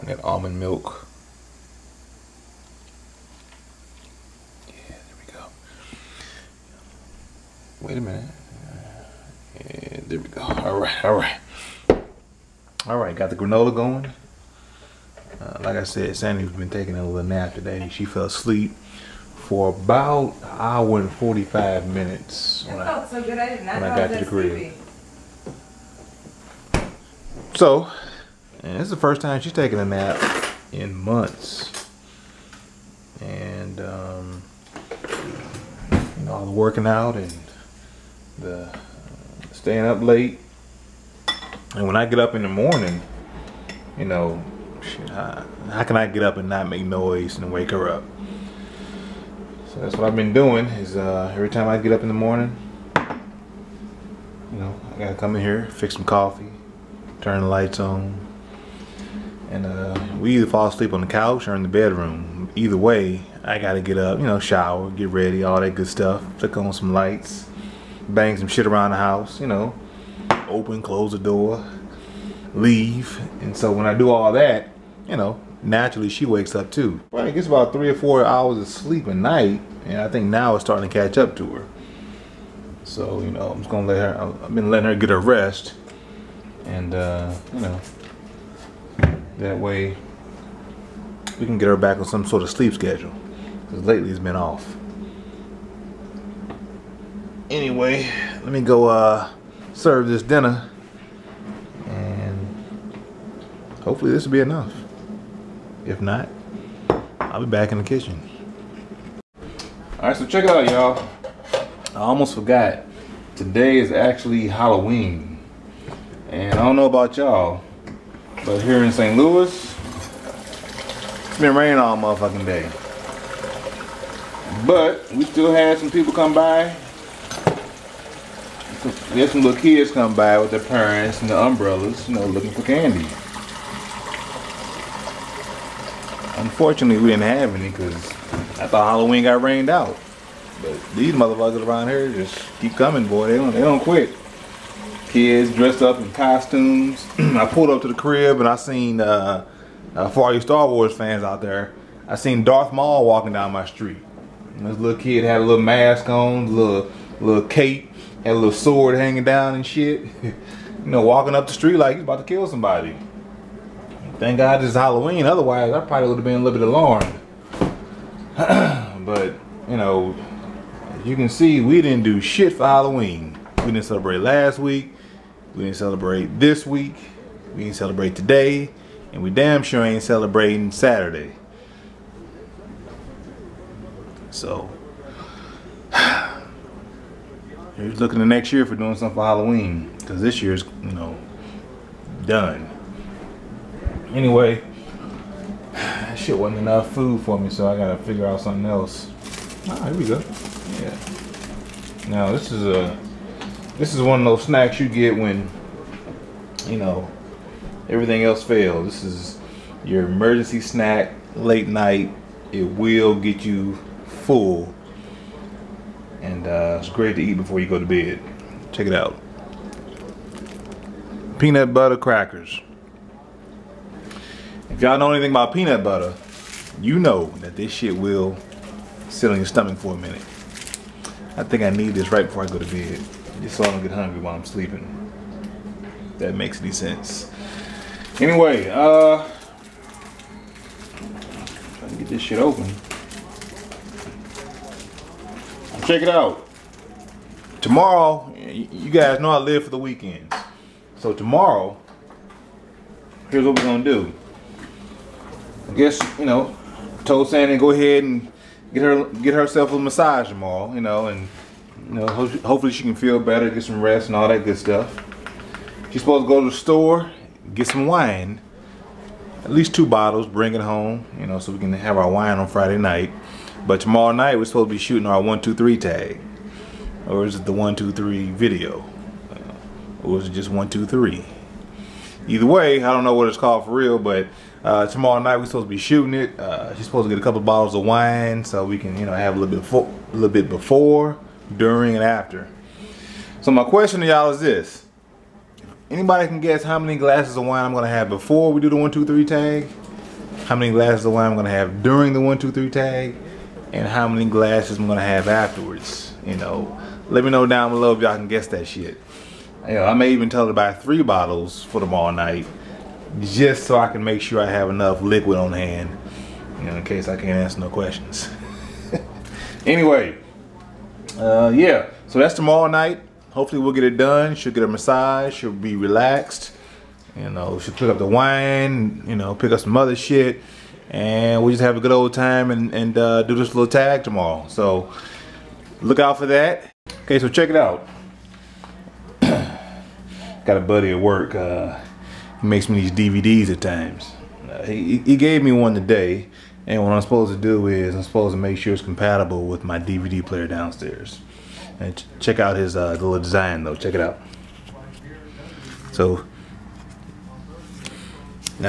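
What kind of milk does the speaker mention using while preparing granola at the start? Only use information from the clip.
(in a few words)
almond milk.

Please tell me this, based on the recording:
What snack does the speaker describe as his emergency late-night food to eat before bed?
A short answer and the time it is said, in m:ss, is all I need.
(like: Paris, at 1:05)
peanut butter crackers, at 3:41.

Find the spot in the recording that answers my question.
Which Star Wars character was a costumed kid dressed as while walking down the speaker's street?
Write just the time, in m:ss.
2:32.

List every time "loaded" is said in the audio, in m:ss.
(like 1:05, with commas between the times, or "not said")
not said.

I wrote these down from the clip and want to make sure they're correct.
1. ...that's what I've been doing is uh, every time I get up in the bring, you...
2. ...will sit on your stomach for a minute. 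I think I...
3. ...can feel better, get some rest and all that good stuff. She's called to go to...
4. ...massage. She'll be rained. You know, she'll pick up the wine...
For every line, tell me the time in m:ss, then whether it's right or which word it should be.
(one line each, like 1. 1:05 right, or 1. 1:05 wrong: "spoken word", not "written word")
1. 0:49 wrong: "morning", not "bring"
2. 3:47 right
3. 4:22 wrong: "supposed", not "called"
4. 5:24 wrong: "relaxed", not "rained".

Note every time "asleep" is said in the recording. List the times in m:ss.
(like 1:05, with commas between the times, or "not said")
0:18, 1:00.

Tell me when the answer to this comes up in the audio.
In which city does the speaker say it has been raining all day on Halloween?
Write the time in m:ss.
1:58.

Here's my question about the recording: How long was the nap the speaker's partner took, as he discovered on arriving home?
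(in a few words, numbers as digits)
an hour and 45 minutes.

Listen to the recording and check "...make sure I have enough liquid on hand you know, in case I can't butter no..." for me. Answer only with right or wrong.
wrong.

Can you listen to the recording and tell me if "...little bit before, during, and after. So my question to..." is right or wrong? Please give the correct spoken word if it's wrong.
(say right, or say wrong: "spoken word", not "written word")
right.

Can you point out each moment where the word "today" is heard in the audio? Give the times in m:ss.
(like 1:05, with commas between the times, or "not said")
0:17, 1:53, 2:58, 5:45.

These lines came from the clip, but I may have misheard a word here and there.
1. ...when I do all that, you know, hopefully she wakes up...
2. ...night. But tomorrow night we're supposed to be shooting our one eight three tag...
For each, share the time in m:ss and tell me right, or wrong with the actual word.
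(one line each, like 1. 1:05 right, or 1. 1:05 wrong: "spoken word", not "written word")
1. 1:13 wrong: "naturally", not "hopefully"
2. 4:32 wrong: "two", not "eight".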